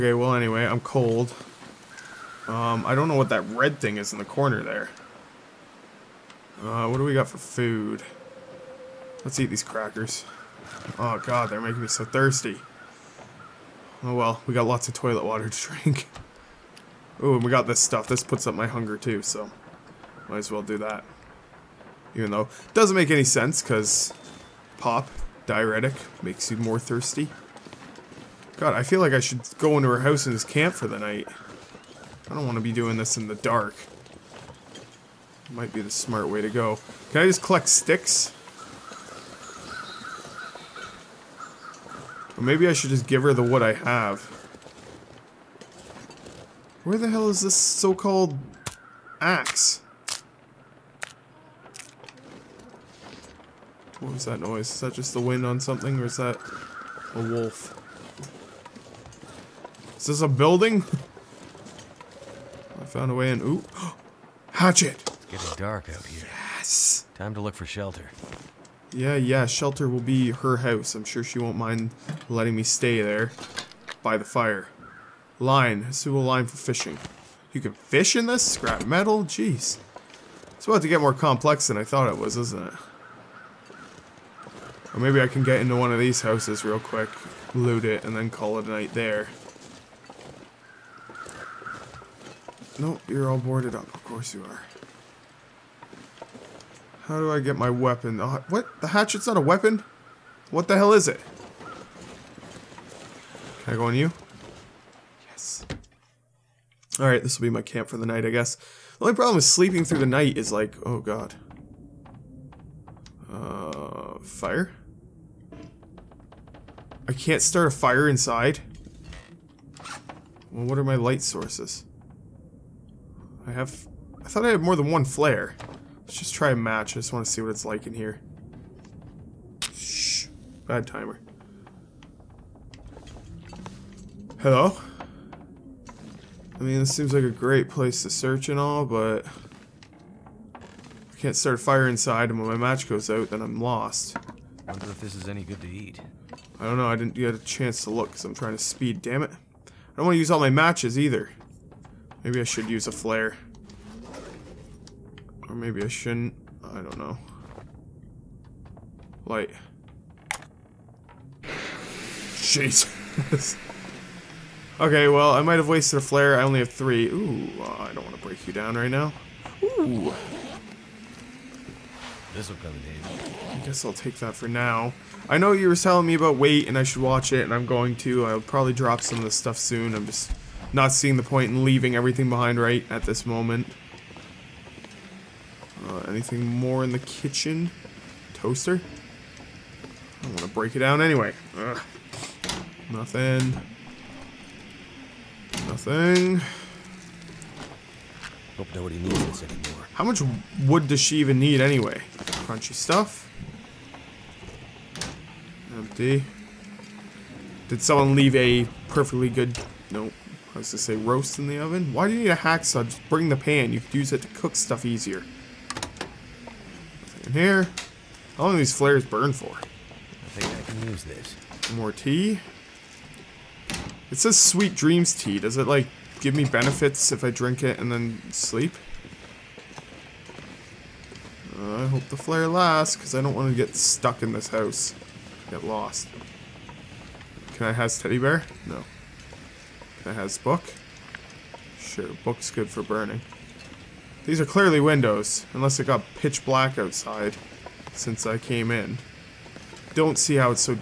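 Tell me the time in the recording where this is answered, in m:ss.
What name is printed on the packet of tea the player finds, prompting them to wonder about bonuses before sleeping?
3:44.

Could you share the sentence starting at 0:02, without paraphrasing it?
Um, I don't know what that red thing is in the corner there.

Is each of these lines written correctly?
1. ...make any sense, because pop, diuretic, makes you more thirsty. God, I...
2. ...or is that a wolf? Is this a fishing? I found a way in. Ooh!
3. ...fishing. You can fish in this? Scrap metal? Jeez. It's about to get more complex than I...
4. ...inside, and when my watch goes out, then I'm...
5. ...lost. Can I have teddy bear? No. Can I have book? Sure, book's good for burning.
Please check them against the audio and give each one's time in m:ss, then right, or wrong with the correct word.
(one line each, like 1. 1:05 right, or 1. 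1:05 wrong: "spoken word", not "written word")
1. 0:22 right
2. 0:55 wrong: "building", not "fishing"
3. 1:16 right
4. 2:21 wrong: "match", not "watch"
5. 3:55 right.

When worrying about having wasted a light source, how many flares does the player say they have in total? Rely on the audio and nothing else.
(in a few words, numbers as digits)
3.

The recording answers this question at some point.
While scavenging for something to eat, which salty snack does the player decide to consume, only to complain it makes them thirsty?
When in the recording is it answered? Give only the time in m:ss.
0:09.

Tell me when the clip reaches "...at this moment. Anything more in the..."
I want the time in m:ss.
3:02.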